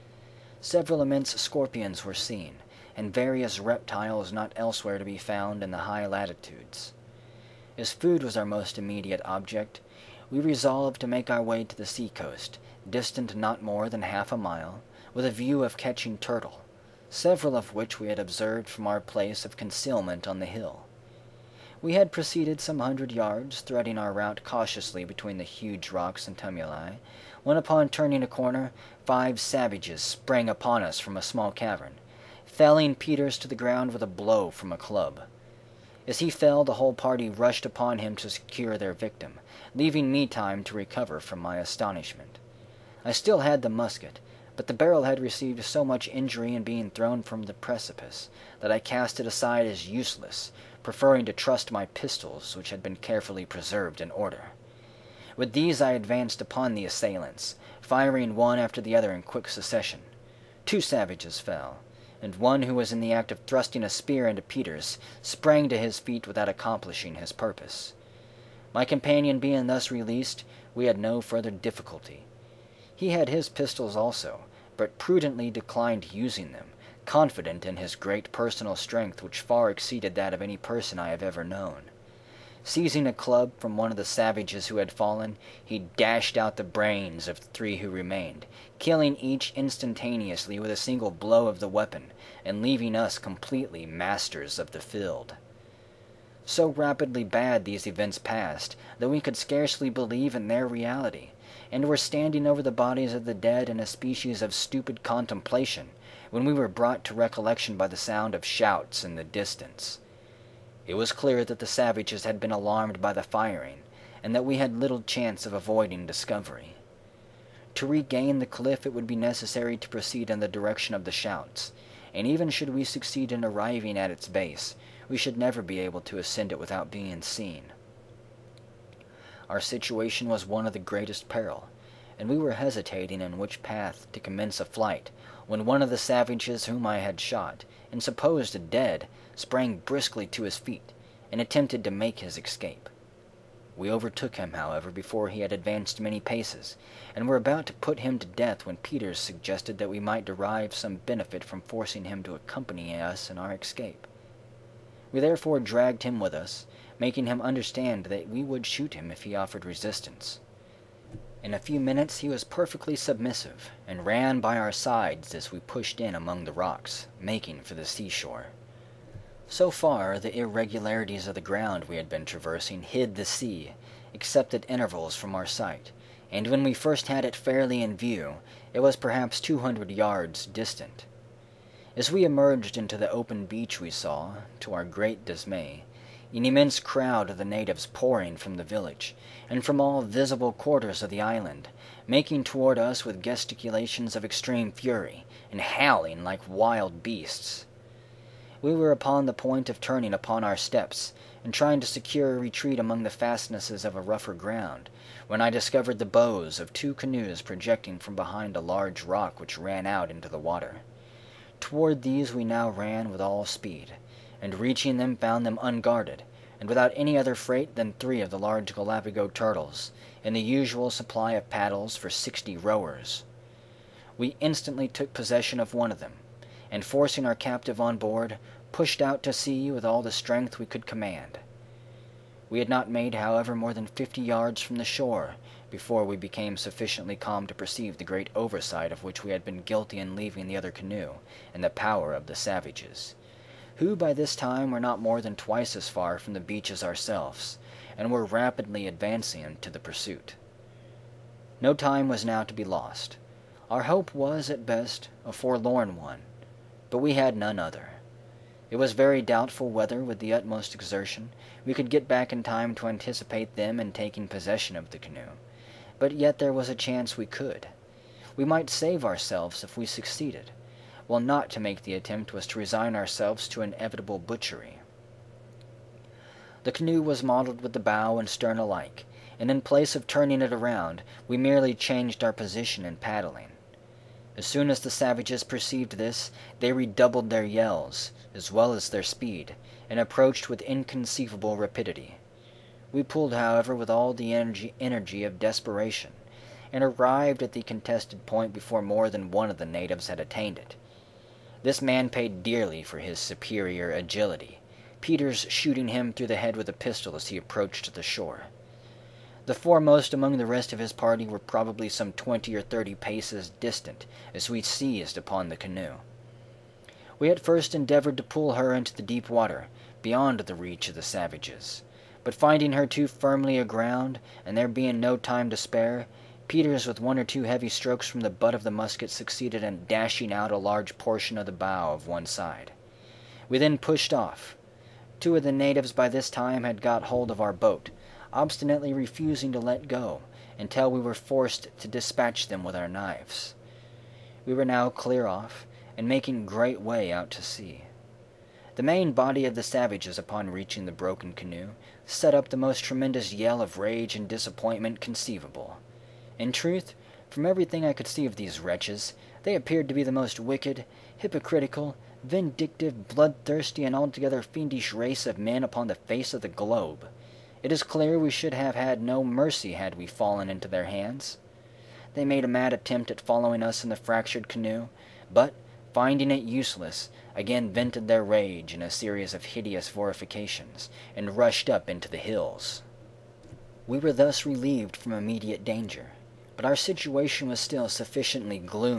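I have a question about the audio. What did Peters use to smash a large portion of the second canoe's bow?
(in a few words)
the butt of the musket.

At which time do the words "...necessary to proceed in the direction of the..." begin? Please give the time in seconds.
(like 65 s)
119 s.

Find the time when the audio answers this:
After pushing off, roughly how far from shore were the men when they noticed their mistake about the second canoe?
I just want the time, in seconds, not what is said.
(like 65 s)
233 s.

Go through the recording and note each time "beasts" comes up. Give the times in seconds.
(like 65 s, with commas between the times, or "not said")
197 s.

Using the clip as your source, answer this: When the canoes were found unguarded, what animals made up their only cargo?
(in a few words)
Galapago turtles.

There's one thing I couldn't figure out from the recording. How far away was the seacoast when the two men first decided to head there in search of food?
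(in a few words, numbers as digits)
half a mile.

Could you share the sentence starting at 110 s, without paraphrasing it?
It was clear that the savages had been alarmed by the firing, and that we had little chance of avoiding discovery.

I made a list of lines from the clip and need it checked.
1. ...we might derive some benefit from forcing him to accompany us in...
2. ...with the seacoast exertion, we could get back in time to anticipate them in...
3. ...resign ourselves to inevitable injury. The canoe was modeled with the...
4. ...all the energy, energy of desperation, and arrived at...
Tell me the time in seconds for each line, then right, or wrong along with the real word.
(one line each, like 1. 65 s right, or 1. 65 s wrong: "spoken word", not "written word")
1. 149 s right
2. 260 s wrong: "utmost", not "seacoast"
3. 272 s wrong: "butchery", not "injury"
4. 293 s right.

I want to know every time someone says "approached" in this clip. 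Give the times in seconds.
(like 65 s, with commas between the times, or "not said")
290 s, 307 s.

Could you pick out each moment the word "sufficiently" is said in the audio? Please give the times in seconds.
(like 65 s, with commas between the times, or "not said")
236 s, 387 s.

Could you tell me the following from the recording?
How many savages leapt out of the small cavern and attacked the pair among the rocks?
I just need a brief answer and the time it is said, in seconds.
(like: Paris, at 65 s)
5, at 29 s.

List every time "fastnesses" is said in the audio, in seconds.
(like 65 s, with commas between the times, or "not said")
203 s.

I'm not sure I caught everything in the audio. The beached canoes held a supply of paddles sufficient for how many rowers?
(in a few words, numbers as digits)
60.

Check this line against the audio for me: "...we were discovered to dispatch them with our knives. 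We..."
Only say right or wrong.
wrong.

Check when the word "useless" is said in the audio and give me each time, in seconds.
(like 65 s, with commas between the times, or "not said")
49 s, 376 s.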